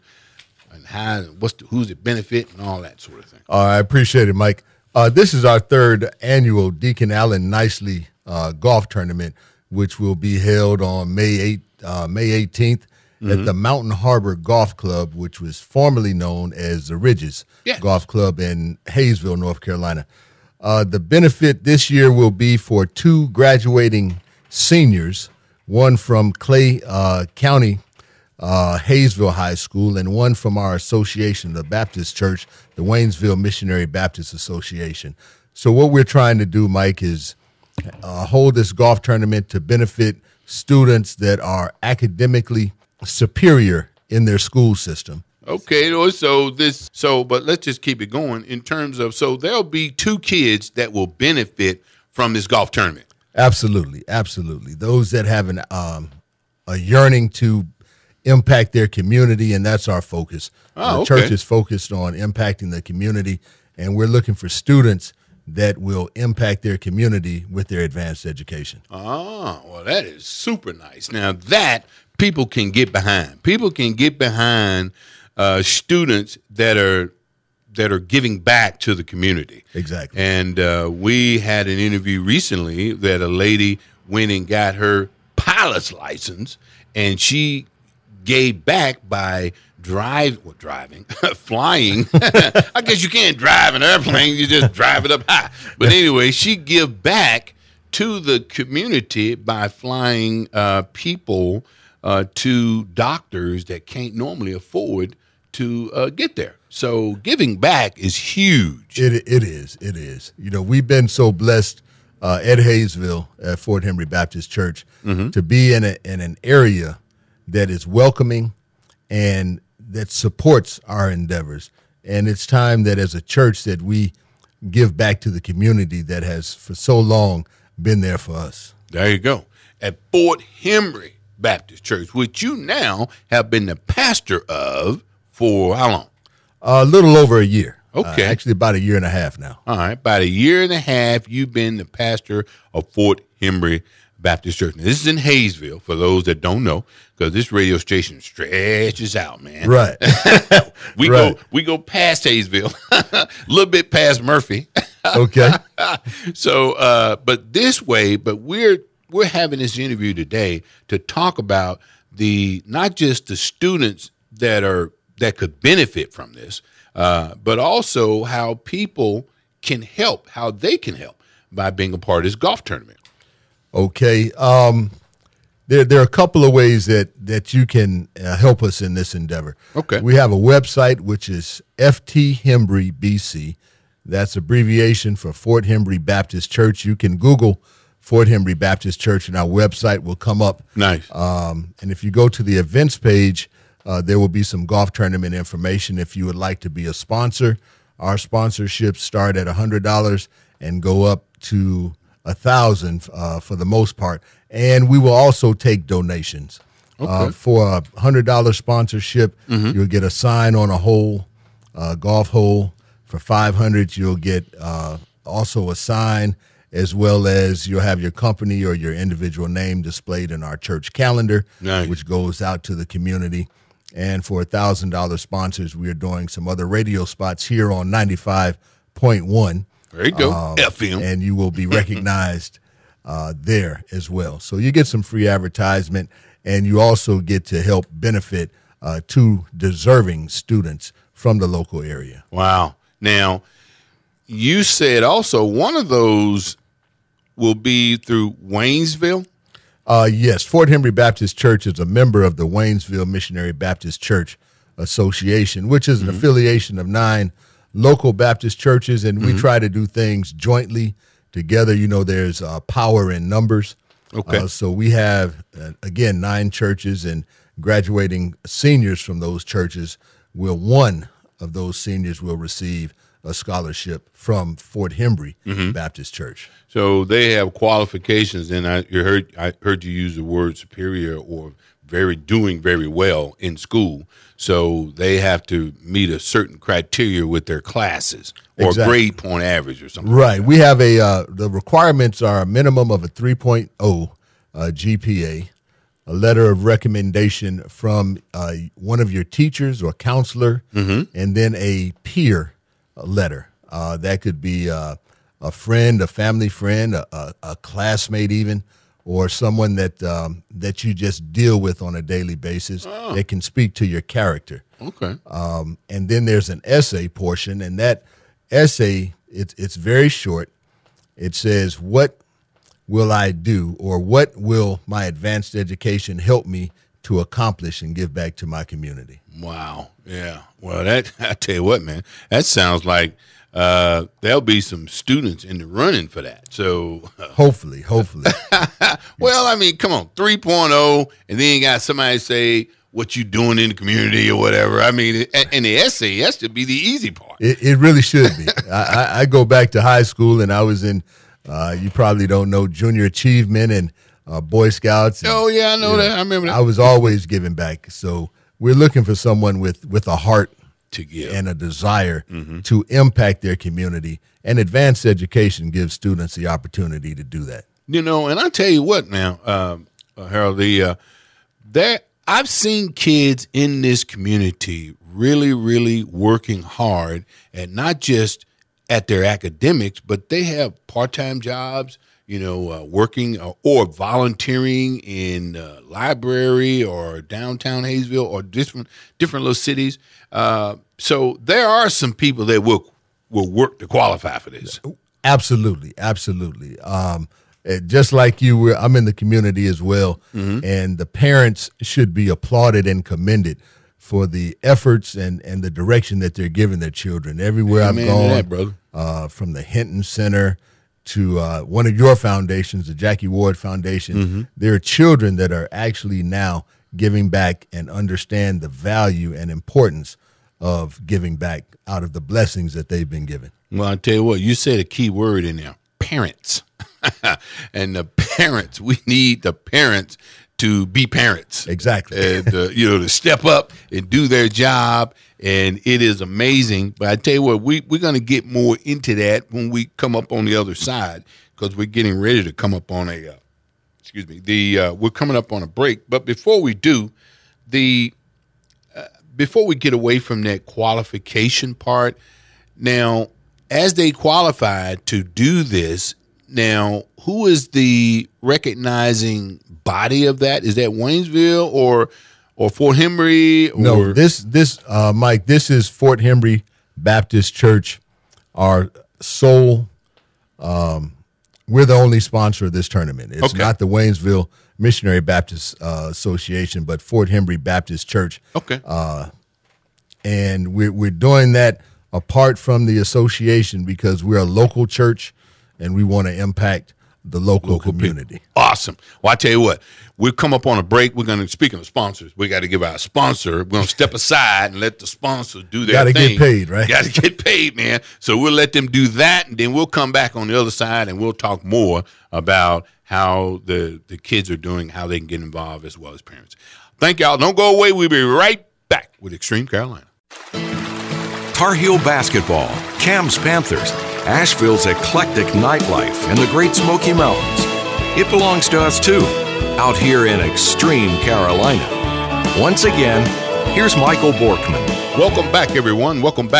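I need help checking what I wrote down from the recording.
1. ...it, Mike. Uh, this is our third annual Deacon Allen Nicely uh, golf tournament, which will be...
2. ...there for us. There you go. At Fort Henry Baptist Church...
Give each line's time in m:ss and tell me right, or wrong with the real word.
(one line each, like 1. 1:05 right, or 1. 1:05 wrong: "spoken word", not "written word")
1. 0:04 right
2. 2:08 right.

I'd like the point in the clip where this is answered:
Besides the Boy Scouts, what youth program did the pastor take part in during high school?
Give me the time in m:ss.
5:52.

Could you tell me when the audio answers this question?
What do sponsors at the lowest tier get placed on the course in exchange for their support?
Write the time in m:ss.
3:30.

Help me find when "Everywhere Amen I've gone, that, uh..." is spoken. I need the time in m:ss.
6:47.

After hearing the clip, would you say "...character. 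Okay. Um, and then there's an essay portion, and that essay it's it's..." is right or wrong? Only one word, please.
right.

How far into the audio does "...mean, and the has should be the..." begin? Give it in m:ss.
5:44.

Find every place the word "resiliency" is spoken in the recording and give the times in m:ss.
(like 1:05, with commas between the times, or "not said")
not said.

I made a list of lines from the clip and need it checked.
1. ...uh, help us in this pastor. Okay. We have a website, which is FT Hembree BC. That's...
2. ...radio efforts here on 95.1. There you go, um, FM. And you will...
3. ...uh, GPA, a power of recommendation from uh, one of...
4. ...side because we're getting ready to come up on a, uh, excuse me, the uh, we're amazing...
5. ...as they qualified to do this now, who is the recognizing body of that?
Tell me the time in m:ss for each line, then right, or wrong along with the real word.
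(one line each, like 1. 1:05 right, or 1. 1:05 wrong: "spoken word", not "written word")
1. 2:58 wrong: "endeavor", not "pastor"
2. 3:46 wrong: "spots", not "efforts"
3. 4:54 wrong: "letter", not "power"
4. 7:20 wrong: "coming", not "amazing"
5. 7:33 right.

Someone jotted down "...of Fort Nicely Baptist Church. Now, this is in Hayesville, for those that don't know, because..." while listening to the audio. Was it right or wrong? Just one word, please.
wrong.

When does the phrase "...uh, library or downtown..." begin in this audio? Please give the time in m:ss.
6:25.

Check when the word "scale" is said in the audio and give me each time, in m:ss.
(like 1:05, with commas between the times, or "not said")
not said.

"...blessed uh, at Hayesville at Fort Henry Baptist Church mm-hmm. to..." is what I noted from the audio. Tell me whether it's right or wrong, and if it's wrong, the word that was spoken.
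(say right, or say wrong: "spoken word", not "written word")
right.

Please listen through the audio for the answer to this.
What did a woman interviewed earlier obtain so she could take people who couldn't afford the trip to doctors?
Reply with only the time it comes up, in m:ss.
1:25.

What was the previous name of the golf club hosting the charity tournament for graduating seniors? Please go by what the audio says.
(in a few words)
The Ridges.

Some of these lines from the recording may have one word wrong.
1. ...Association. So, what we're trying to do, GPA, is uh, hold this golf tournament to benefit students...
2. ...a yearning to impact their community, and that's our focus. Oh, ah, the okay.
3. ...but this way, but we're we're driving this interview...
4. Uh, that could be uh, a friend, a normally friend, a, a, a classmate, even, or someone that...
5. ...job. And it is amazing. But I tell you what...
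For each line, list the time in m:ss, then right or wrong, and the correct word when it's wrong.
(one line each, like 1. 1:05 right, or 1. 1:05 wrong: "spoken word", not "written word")
1. 0:34 wrong: "Mike", not "GPA"
2. 0:56 right
3. 2:37 wrong: "having", not "driving"
4. 5:03 wrong: "family", not "normally"
5. 7:14 right.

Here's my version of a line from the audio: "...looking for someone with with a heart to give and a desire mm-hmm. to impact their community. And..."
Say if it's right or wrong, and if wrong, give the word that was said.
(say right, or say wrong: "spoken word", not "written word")
right.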